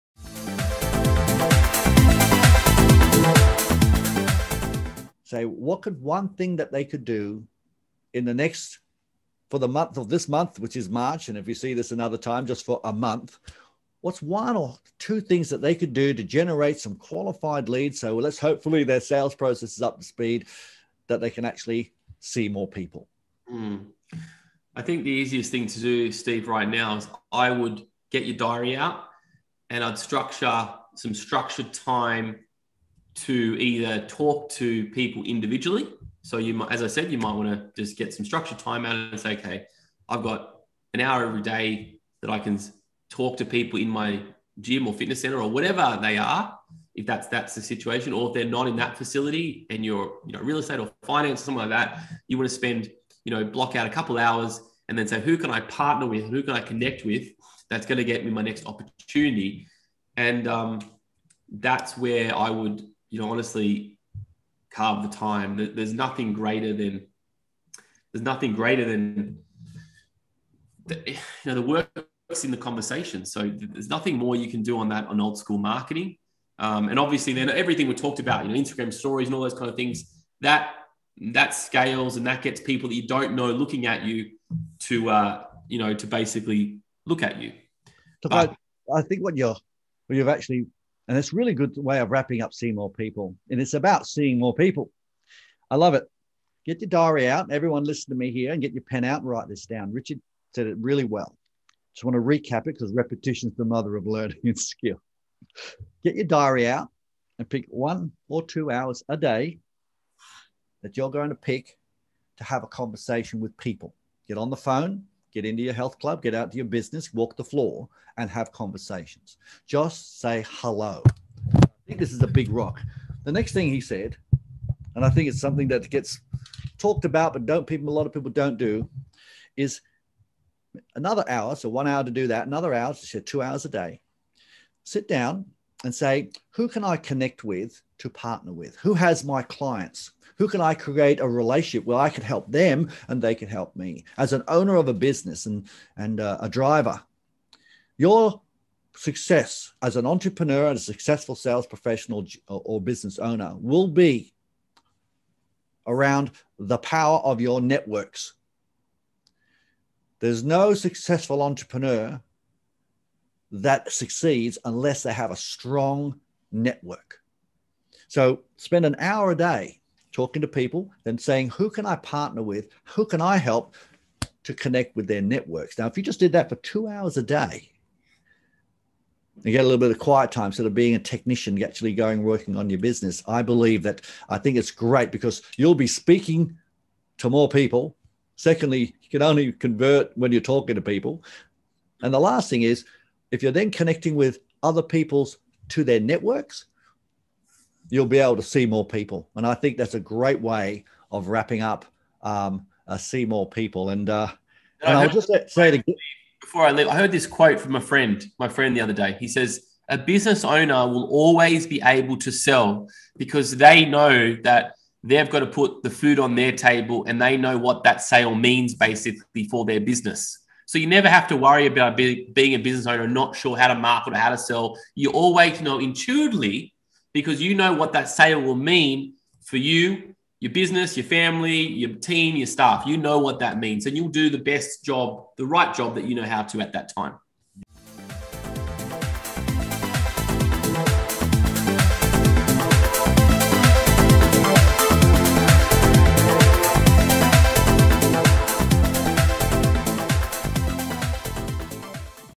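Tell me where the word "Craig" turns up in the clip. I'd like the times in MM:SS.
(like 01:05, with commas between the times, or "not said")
not said.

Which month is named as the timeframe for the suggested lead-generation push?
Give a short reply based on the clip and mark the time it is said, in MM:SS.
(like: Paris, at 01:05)
March, at 00:10.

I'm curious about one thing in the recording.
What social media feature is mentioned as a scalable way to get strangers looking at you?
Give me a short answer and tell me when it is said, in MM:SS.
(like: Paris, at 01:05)
Instagram stories, at 01:18.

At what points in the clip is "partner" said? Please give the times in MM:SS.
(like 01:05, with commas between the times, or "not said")
00:55, 02:18, 02:51.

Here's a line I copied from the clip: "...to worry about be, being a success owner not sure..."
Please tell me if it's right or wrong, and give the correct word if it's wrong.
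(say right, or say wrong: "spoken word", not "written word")
wrong: "business", not "success".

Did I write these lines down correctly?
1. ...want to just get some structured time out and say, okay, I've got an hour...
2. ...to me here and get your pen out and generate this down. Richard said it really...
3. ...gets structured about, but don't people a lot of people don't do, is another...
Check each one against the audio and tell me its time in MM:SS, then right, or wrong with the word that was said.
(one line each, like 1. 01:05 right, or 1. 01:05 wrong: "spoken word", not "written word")
1. 00:37 right
2. 01:38 wrong: "write", not "generate"
3. 02:05 wrong: "talked", not "structured".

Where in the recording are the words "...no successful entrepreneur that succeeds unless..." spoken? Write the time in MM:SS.
02:40.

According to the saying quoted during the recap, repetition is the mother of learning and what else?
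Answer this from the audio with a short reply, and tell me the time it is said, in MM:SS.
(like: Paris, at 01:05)
skill, at 01:44.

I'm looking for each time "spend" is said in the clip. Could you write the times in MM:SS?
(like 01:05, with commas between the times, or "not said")
00:52, 02:48.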